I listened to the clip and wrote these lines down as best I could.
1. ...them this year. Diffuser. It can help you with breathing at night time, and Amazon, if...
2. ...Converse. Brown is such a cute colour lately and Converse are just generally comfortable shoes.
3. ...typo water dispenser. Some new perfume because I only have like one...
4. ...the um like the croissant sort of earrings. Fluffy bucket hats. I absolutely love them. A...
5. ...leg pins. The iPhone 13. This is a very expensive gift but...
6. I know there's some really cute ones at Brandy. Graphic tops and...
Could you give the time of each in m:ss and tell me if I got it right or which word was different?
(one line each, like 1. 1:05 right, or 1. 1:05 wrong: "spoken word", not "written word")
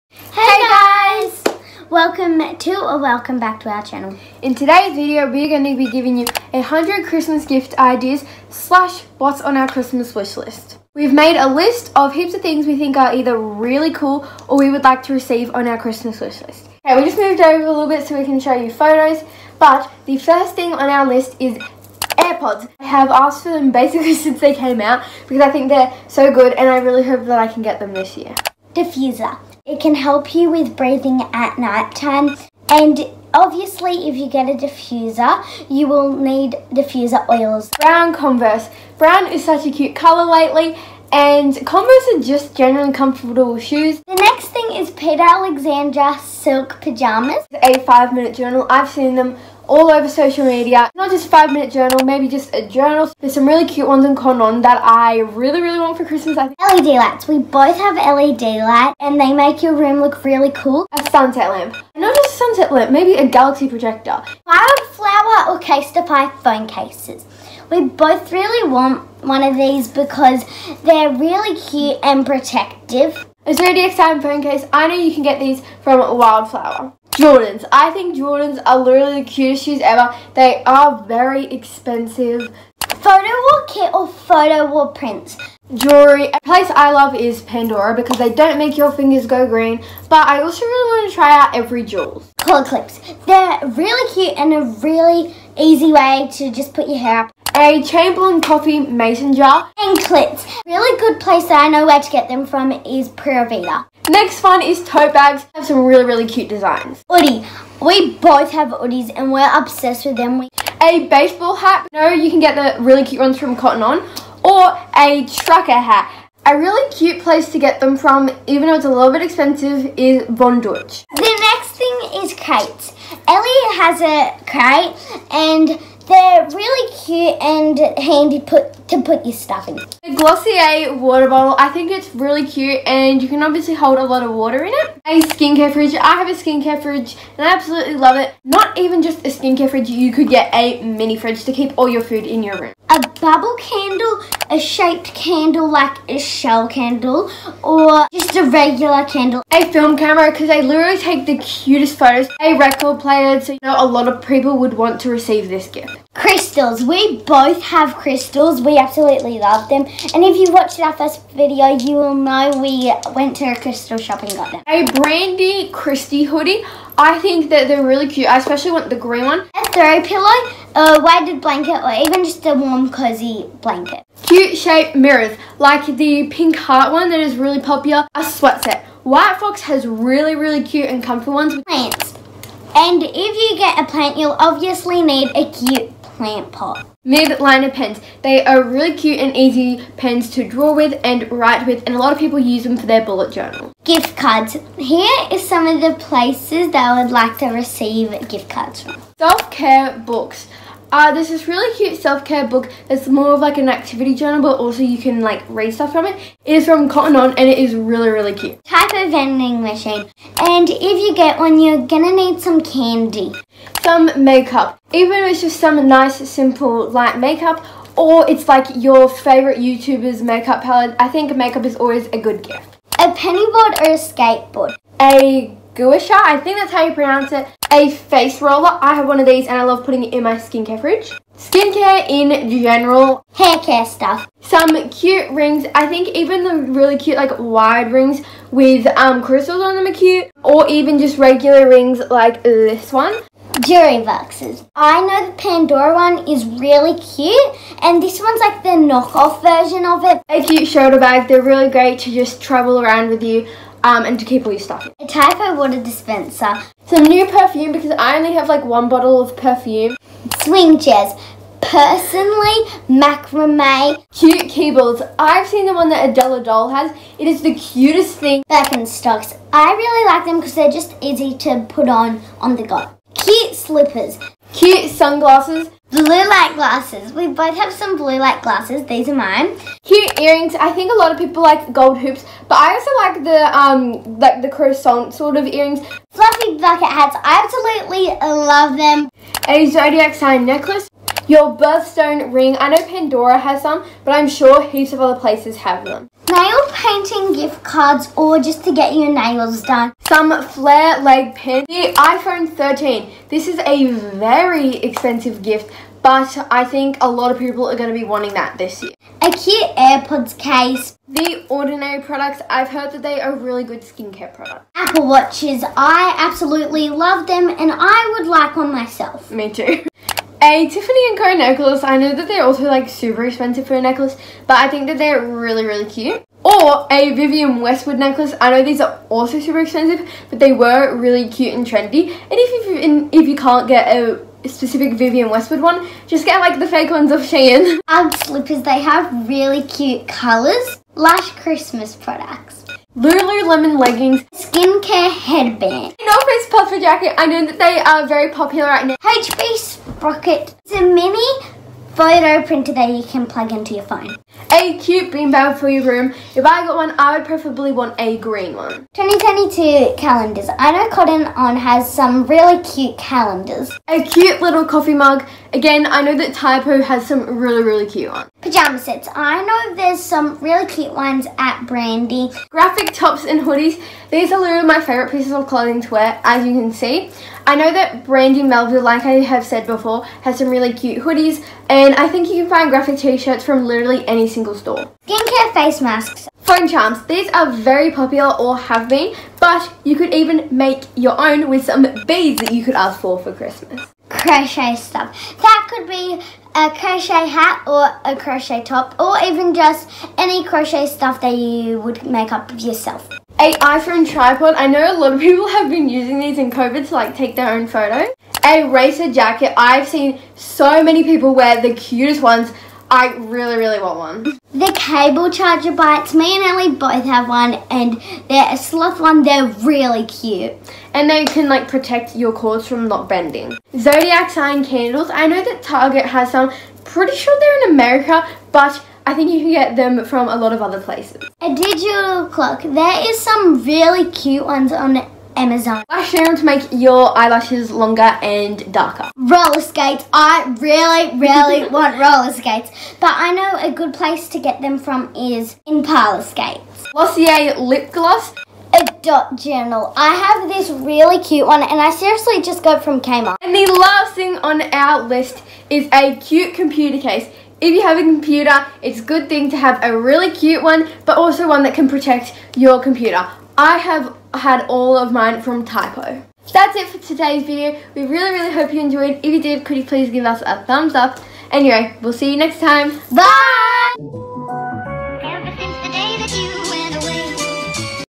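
1. 0:27 wrong: "Obviously", not "Amazon"
2. 0:38 right
3. 4:15 right
4. 4:43 right
5. 5:01 right
6. 6:09 right.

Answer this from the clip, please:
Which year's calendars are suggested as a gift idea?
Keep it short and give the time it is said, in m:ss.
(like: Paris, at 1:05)
2022, at 5:58.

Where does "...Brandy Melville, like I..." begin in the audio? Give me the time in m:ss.
6:18.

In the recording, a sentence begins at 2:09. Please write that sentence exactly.
The Glossier water bottle, I think it's really cute and you can obviously hold a lot of water in it.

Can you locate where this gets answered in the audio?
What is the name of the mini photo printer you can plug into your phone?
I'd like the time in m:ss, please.
5:48.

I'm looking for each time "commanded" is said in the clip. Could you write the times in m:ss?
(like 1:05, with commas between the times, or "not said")
not said.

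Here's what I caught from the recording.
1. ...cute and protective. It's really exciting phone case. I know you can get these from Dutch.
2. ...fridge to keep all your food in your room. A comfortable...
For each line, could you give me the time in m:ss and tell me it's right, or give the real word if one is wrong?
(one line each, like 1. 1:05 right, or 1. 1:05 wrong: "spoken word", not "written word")
1. 1:11 wrong: "Wildflower", not "Dutch"
2. 2:21 wrong: "bubble", not "comfortable".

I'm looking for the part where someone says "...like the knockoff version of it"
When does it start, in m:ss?
4:08.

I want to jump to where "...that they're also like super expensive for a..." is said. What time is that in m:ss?
5:22.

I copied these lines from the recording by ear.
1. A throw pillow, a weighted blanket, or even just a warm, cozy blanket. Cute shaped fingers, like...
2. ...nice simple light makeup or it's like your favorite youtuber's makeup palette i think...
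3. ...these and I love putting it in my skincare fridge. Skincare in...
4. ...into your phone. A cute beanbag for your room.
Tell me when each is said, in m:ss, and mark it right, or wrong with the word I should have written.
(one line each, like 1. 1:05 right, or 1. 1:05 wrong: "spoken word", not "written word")
1. 2:49 wrong: "mirrors", not "fingers"
2. 3:35 right
3. 3:49 right
4. 5:53 right.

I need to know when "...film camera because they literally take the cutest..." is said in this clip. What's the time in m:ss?
2:29.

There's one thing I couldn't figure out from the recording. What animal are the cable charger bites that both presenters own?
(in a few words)
Sloth.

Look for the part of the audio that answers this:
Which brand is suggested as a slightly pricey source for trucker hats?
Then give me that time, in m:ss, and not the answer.
2:00.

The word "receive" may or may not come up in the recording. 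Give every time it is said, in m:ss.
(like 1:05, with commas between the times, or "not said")
0:15, 2:35, 3:17.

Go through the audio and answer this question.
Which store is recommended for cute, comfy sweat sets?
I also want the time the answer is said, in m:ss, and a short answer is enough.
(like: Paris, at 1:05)
White Fox, at 2:59.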